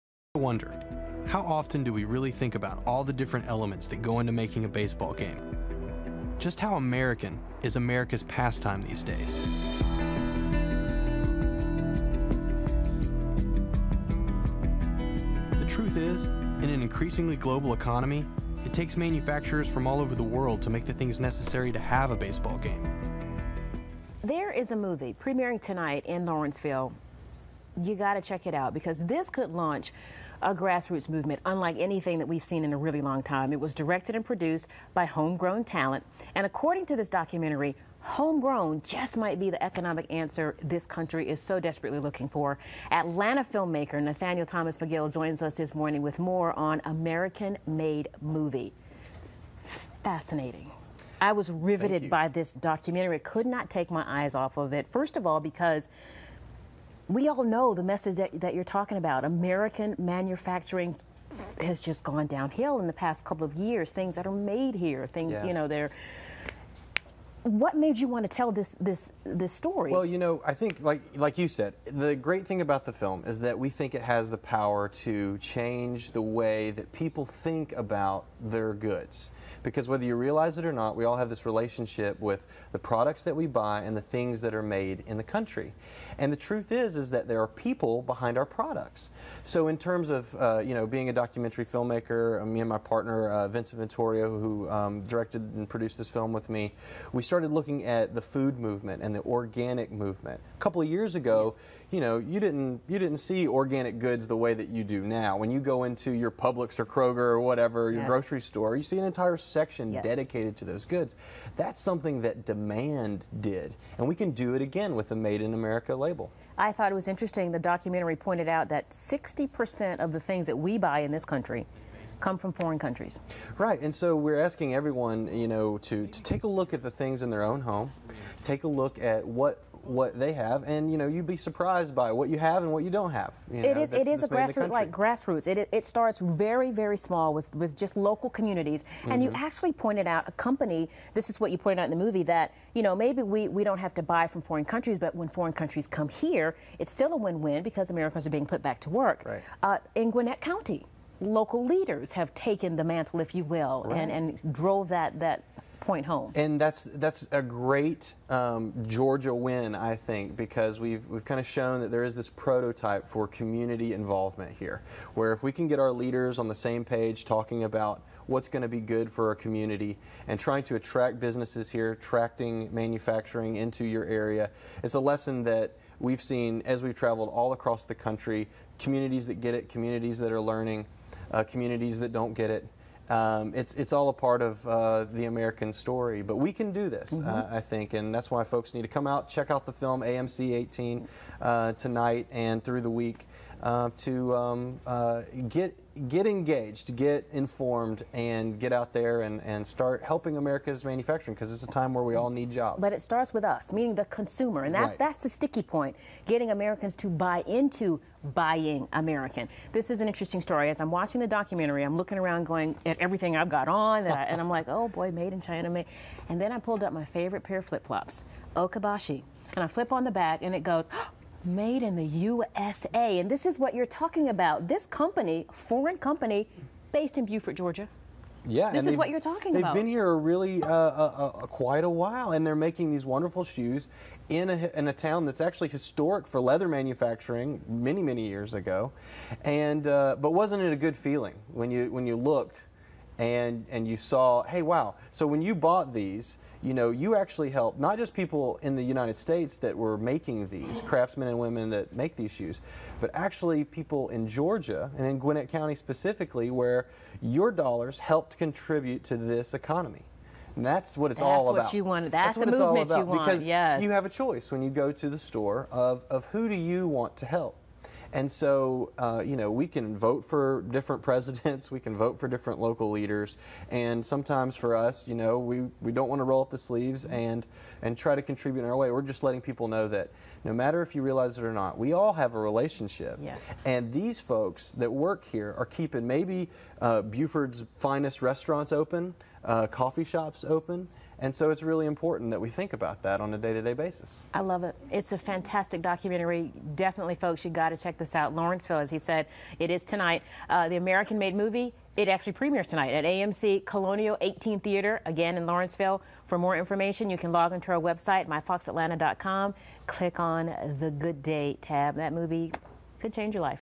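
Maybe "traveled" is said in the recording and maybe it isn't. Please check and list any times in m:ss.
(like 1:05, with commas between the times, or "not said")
2:56.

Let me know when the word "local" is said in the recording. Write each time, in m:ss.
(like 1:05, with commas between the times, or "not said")
2:17, 2:31, 4:32.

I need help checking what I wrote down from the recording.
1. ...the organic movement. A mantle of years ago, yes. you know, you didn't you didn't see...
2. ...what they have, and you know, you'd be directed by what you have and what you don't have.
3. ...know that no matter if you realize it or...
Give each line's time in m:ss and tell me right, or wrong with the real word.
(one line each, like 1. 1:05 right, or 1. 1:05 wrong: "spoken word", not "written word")
1. 1:39 wrong: "couple", not "mantle"
2. 2:09 wrong: "surprised", not "directed"
3. 4:39 right.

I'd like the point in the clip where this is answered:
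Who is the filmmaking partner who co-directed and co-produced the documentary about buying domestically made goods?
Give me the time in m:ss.
1:33.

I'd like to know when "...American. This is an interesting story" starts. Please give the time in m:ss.
3:28.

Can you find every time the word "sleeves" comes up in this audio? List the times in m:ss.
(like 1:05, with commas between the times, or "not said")
4:36.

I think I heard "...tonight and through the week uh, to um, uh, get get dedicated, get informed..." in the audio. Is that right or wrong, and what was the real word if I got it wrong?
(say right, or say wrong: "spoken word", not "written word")
wrong: "engaged", not "dedicated".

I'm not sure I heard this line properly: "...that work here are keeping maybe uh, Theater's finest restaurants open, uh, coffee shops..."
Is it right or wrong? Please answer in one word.
wrong.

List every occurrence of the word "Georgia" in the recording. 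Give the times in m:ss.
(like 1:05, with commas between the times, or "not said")
2:38, 3:47, 4:14.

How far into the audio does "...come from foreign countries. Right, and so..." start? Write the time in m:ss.
2:02.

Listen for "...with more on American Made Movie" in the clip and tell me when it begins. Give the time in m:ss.
0:46.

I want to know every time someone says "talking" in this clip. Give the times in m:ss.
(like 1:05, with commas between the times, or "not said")
0:58, 2:47, 3:43, 3:49.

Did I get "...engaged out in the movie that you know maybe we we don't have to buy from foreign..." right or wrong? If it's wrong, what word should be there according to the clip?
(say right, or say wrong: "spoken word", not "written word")
wrong: "pointed", not "engaged".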